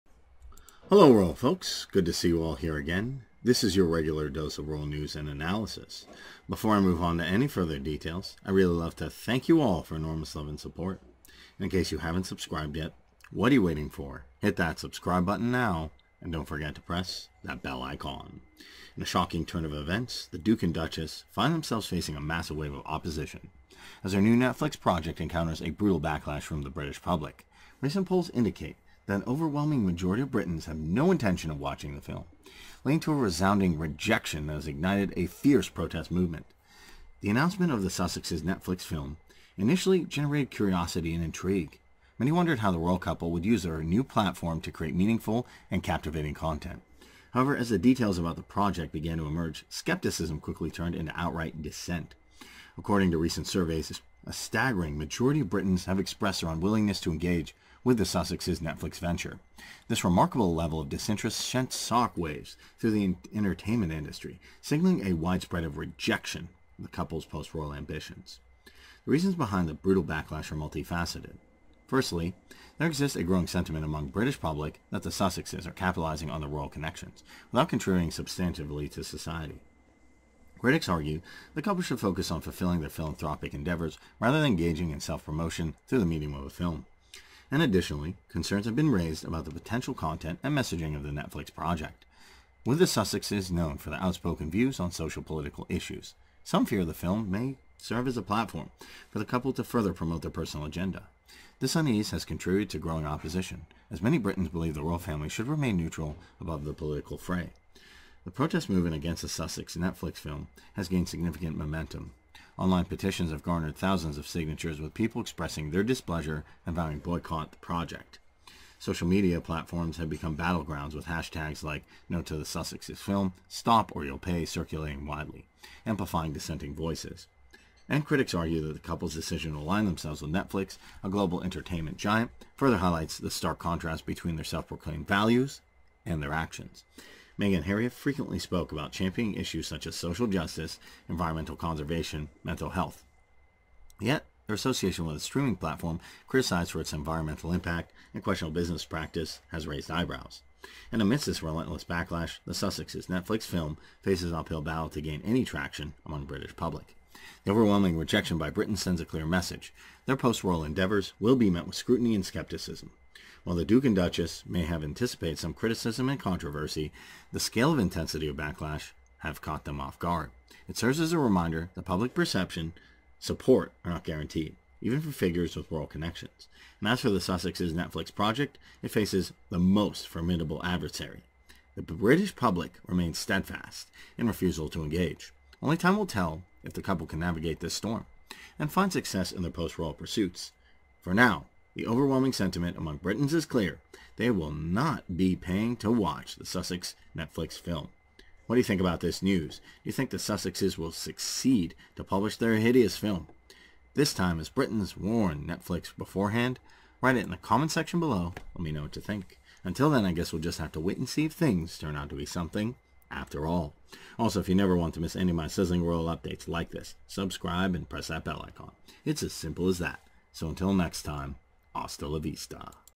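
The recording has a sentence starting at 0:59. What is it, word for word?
This remarkable level of disinterest sent shock waves through the entertainment industry, signaling a widespread of rejection of the couple's post-royal ambitions.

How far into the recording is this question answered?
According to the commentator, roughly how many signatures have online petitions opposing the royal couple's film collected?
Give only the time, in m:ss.
1:53.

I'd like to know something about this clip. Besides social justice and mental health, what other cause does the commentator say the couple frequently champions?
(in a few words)
Environmental conservation.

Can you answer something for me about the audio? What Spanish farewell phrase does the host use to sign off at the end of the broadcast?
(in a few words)
Hasta la vista.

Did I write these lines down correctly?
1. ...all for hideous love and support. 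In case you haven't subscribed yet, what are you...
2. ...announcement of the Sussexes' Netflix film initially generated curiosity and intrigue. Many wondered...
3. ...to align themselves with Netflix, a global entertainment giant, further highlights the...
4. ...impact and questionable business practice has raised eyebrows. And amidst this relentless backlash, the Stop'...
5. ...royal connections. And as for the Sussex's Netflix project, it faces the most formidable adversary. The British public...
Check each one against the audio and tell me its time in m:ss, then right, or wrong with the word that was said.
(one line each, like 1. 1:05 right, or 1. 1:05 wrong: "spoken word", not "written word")
1. 0:09 wrong: "enormous", not "hideous"
2. 0:37 right
3. 2:09 right
4. 2:27 wrong: "Sussexes", not "Stop"
5. 2:55 right.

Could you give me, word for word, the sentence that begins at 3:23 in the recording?
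This time, as Britons warn Netflix beforehand?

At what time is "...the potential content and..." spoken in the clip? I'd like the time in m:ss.
1:29.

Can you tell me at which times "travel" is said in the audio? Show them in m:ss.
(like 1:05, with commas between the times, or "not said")
not said.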